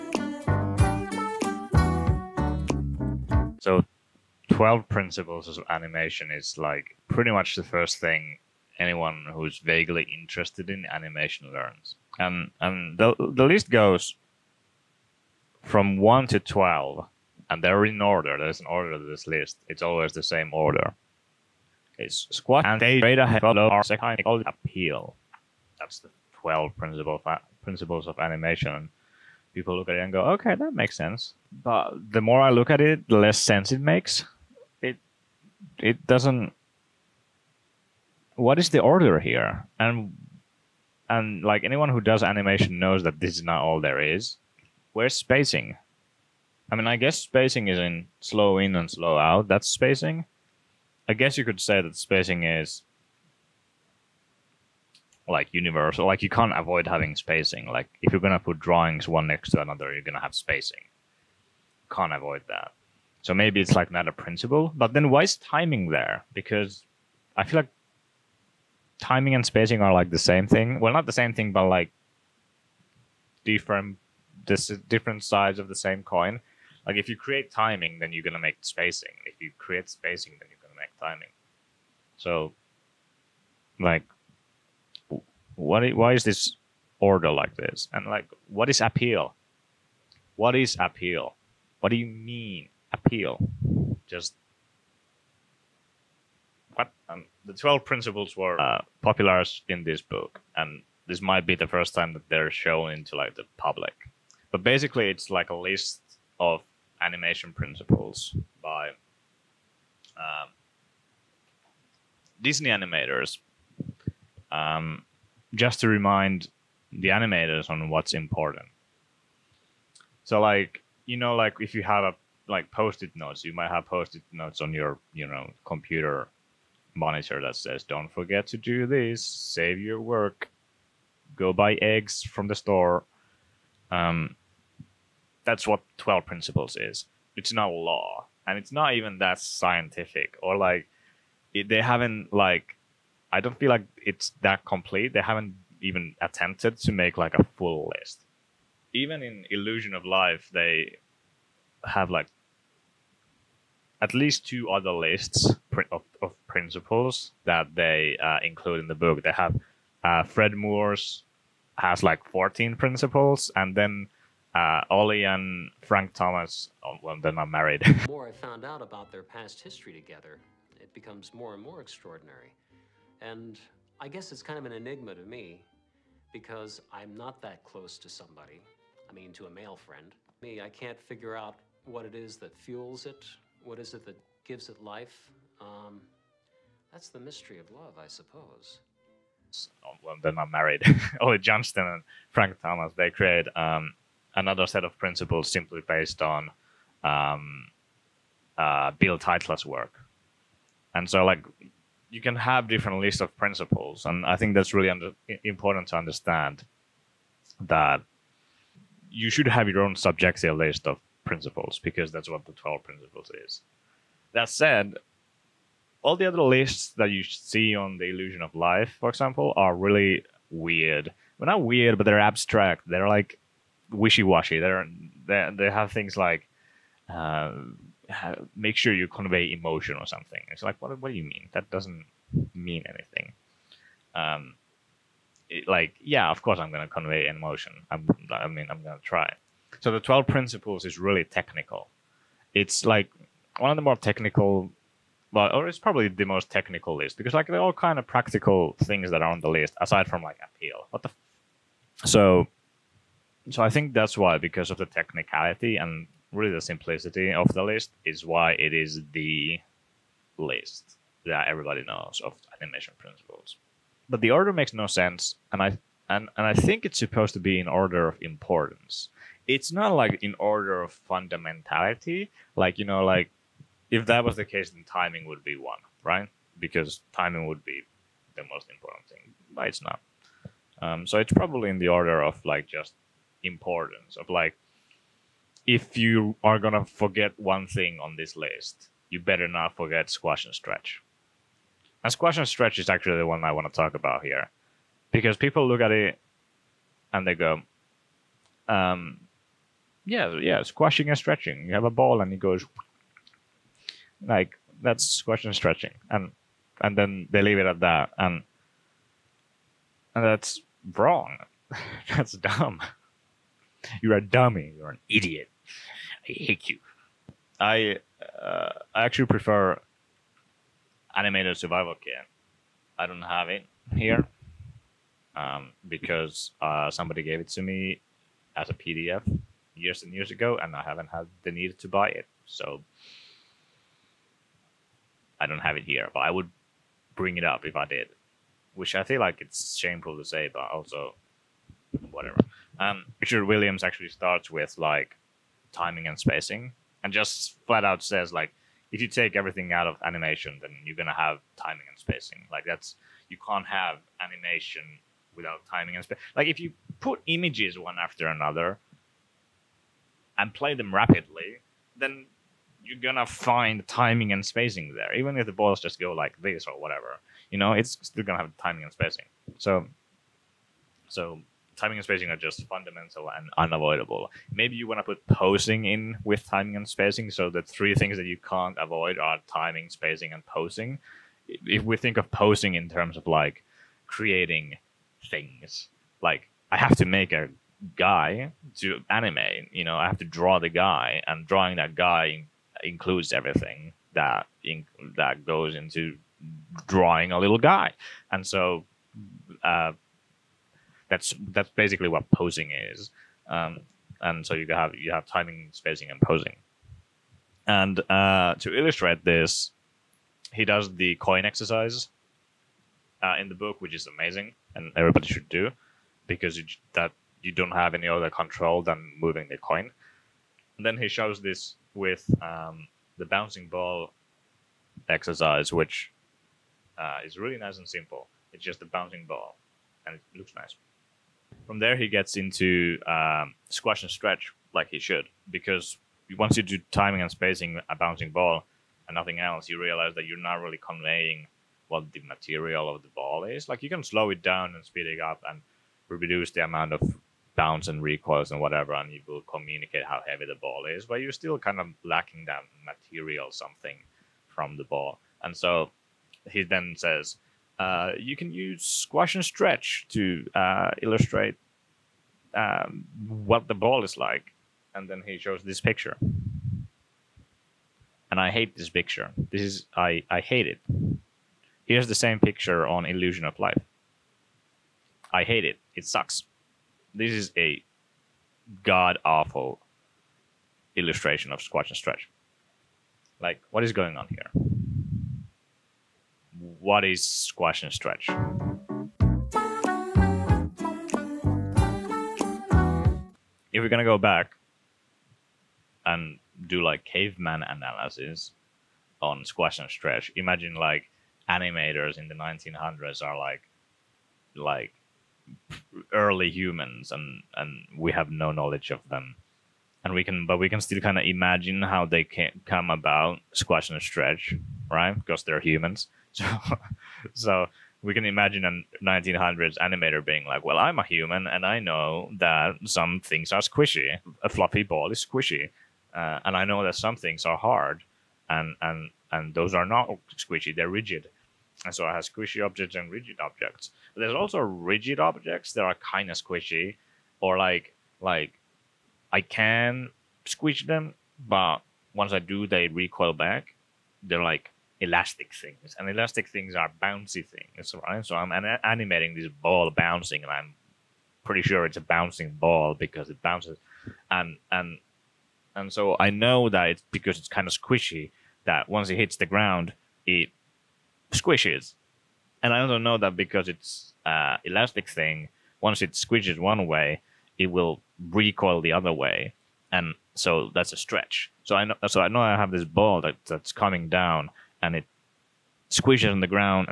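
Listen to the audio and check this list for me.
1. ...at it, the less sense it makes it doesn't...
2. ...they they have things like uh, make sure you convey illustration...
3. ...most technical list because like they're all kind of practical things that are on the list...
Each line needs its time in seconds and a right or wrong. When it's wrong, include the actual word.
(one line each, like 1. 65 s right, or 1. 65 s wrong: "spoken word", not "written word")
1. 32 s right
2. 225 s wrong: "emotion", not "illustration"
3. 246 s right.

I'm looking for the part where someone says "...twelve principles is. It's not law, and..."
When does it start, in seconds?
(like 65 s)
135 s.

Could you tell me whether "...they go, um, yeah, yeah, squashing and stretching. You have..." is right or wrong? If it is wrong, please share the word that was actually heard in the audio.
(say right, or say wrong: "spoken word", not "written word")
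right.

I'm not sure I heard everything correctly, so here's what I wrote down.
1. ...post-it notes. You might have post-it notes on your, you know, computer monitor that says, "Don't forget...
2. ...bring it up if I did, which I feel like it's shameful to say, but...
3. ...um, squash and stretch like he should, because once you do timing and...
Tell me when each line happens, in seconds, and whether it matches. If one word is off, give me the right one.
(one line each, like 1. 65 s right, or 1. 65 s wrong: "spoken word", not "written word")
1. 122 s right
2. 337 s right
3. 433 s right.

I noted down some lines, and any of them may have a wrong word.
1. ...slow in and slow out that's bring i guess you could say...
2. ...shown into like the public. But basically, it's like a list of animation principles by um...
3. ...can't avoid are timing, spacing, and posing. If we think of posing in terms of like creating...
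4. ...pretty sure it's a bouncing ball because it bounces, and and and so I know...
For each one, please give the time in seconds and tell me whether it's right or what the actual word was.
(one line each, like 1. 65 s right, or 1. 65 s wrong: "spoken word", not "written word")
1. 48 s wrong: "spacing", not "bring"
2. 102 s right
3. 378 s right
4. 551 s right.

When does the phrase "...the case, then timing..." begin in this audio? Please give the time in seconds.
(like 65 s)
274 s.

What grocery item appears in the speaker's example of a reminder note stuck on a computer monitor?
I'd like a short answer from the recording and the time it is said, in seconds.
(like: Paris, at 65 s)
Eggs, at 131 s.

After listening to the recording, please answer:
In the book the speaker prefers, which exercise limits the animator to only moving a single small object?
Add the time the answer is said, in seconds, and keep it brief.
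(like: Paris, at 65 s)
The coin exercise, at 411 s.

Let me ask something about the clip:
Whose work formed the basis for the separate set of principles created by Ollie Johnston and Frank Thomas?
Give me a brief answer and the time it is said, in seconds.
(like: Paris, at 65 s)
Bill Tytla, at 198 s.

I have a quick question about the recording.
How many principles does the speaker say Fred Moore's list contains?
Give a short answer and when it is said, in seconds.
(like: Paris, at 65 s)
14, at 162 s.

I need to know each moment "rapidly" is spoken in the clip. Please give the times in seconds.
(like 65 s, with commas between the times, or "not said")
360 s.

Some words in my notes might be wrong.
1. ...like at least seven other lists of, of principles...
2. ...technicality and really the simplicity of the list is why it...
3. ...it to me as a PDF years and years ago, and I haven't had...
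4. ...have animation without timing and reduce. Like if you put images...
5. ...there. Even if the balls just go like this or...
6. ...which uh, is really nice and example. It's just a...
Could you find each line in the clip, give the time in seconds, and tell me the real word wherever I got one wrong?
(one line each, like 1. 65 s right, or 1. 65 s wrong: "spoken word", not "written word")
1. 152 s wrong: "two", not "seven"
2. 254 s right
3. 327 s right
4. 353 s wrong: "space", not "reduce"
5. 364 s right
6. 425 s wrong: "simple", not "example".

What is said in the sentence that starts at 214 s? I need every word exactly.
That said, all the other lists that you see on the illusion of life, for example, are really weird.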